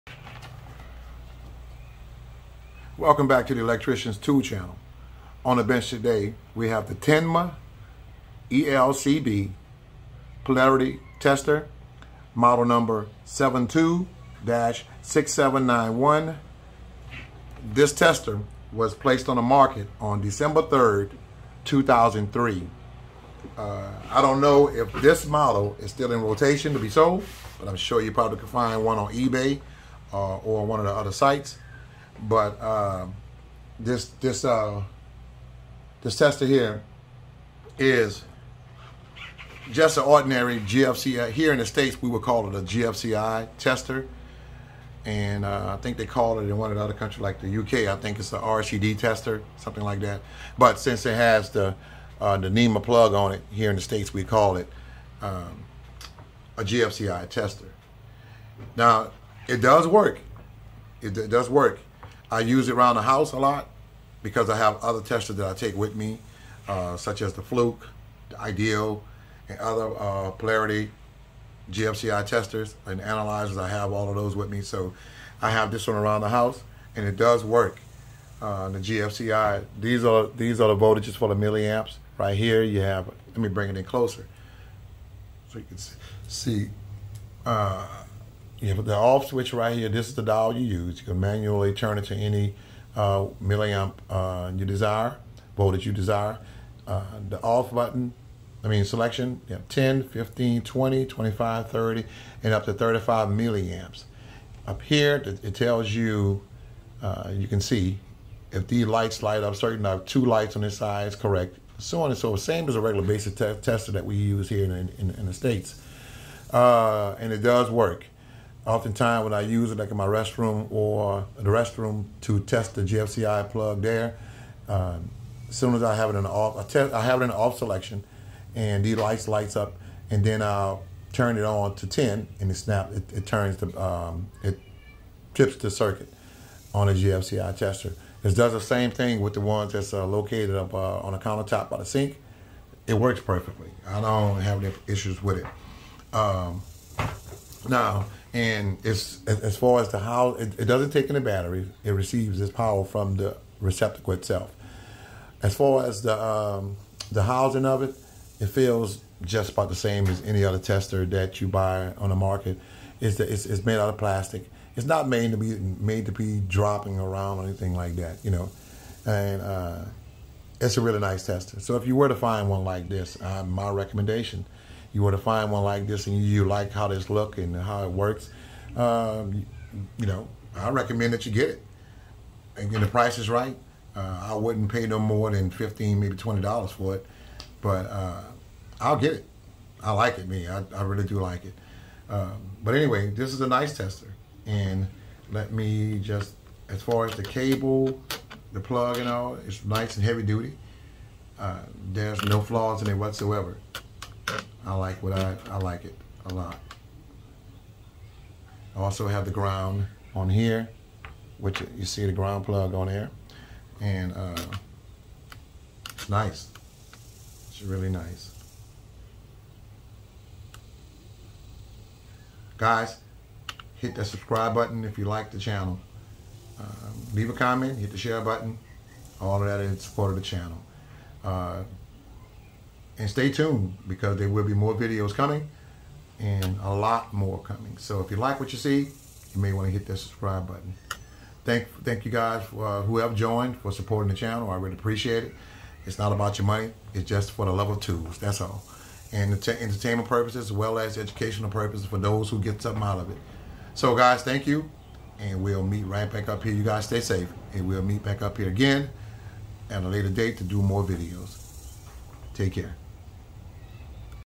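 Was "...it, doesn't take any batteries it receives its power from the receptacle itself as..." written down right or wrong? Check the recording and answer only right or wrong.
right.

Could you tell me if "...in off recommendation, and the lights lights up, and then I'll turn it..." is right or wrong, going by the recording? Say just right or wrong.
wrong.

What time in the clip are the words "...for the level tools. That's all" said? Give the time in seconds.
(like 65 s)
247 s.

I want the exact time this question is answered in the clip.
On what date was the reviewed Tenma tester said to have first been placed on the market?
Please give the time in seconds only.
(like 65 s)
20 s.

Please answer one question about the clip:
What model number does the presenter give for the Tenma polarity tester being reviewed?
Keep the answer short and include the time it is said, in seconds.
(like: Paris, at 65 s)
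72-6791, at 13 s.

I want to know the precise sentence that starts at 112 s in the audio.
Same as a regular basic te tester that we use here in, in, in the States.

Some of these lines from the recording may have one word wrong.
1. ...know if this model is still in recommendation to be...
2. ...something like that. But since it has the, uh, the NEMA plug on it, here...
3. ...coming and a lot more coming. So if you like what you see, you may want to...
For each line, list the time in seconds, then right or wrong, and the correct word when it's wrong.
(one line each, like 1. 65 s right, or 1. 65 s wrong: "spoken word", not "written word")
1. 24 s wrong: "rotation", not "recommendation"
2. 49 s right
3. 235 s right.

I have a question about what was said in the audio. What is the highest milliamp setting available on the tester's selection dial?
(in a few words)
35 milliamps.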